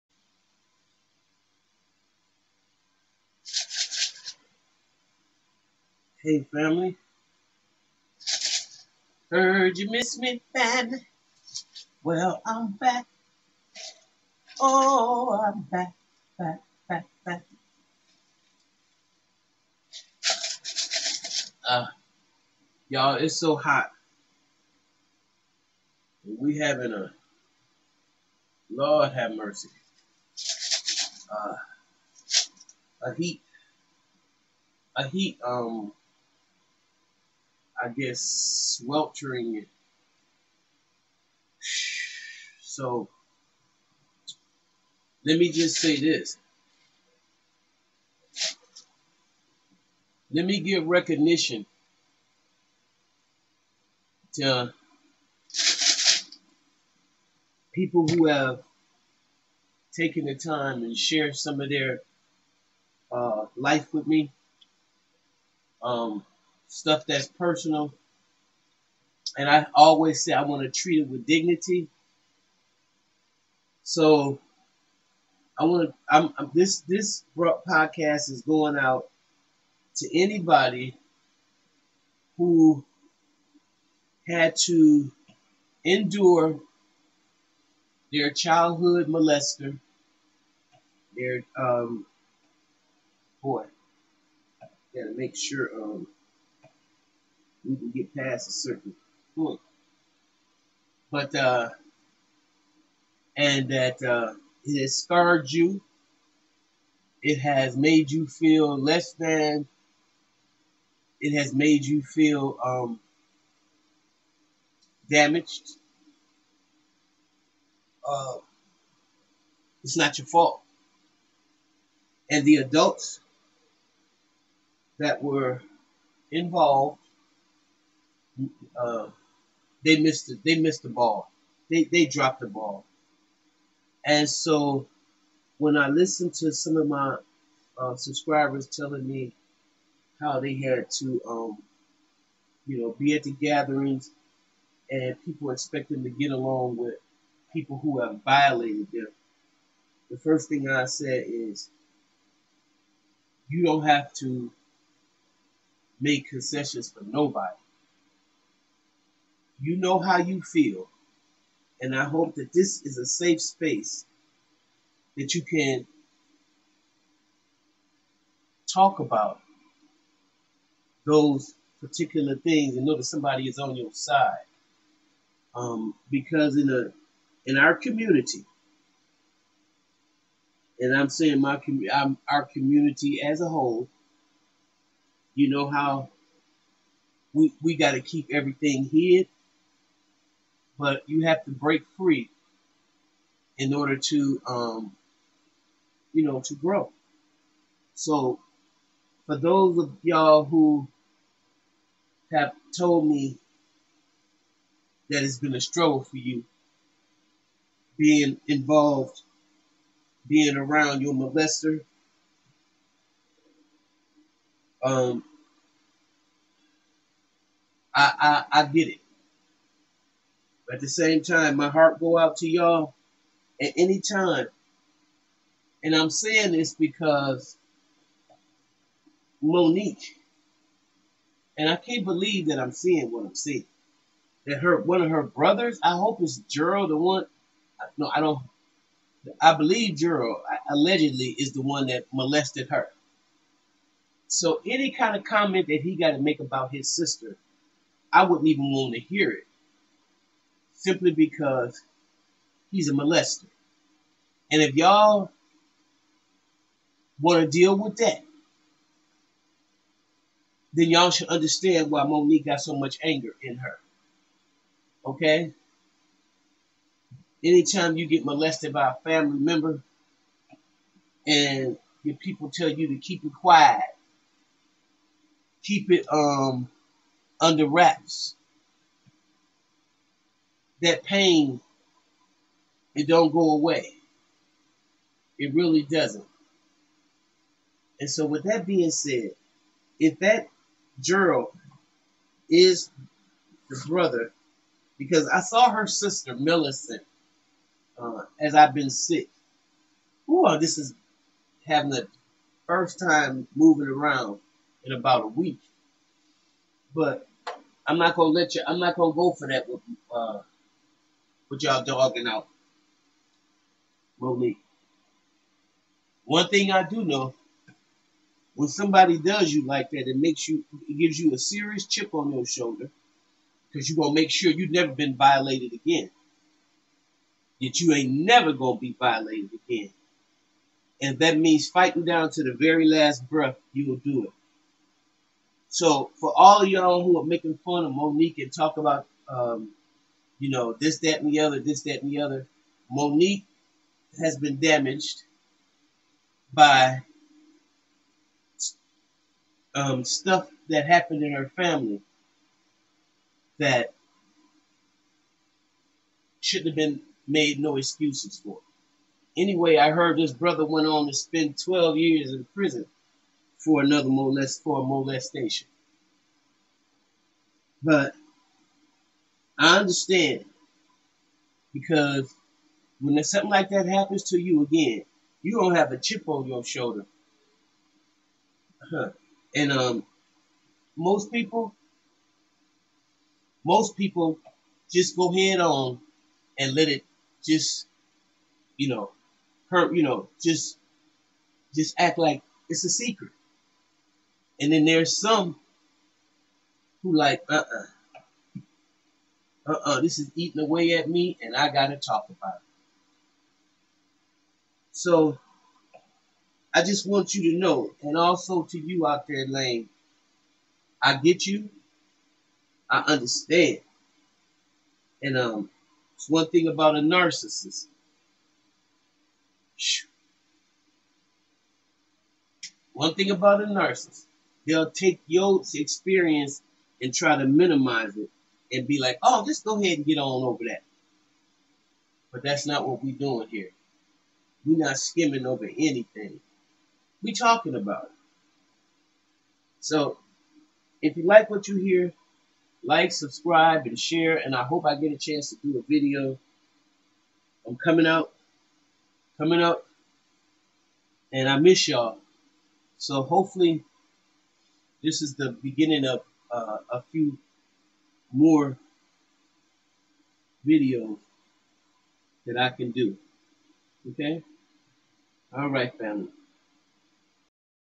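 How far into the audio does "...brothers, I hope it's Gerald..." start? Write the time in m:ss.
3:55.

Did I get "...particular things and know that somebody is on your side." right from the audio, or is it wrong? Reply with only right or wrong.
right.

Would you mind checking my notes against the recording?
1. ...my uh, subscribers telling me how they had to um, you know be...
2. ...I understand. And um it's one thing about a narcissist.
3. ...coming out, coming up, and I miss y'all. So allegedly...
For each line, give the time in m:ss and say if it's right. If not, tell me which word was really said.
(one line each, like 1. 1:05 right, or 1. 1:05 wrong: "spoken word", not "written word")
1. 2:16 right
2. 6:52 right
3. 7:27 wrong: "hopefully", not "allegedly".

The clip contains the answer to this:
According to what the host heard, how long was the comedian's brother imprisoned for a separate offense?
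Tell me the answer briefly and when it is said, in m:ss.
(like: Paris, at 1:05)
12 years, at 6:01.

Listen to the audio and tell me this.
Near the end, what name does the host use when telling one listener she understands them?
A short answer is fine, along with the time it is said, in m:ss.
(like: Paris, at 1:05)
Lane, at 6:49.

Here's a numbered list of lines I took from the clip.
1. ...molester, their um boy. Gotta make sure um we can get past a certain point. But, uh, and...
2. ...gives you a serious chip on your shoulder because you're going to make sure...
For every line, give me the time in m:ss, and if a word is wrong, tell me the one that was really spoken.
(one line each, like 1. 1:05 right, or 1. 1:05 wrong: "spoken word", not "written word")
1. 1:29 right
2. 5:20 right.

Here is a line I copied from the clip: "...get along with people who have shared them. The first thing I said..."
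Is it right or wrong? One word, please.
wrong.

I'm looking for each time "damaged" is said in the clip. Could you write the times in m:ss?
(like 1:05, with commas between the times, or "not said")
1:55, 5:44.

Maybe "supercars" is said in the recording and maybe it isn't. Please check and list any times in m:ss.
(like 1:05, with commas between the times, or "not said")
not said.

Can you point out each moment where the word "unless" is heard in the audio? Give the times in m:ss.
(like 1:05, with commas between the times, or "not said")
not said.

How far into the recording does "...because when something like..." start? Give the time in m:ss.
6:11.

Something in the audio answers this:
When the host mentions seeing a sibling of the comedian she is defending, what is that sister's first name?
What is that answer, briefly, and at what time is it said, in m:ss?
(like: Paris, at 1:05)
Millicent, at 4:56.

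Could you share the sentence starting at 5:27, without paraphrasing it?
That you ain't never going to be violated again.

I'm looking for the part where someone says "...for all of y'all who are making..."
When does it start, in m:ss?
5:36.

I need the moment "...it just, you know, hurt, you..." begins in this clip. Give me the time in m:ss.
6:26.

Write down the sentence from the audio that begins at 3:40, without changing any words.
But at the same time, my heart go out to y'all at any time.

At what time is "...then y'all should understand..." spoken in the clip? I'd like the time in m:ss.
4:20.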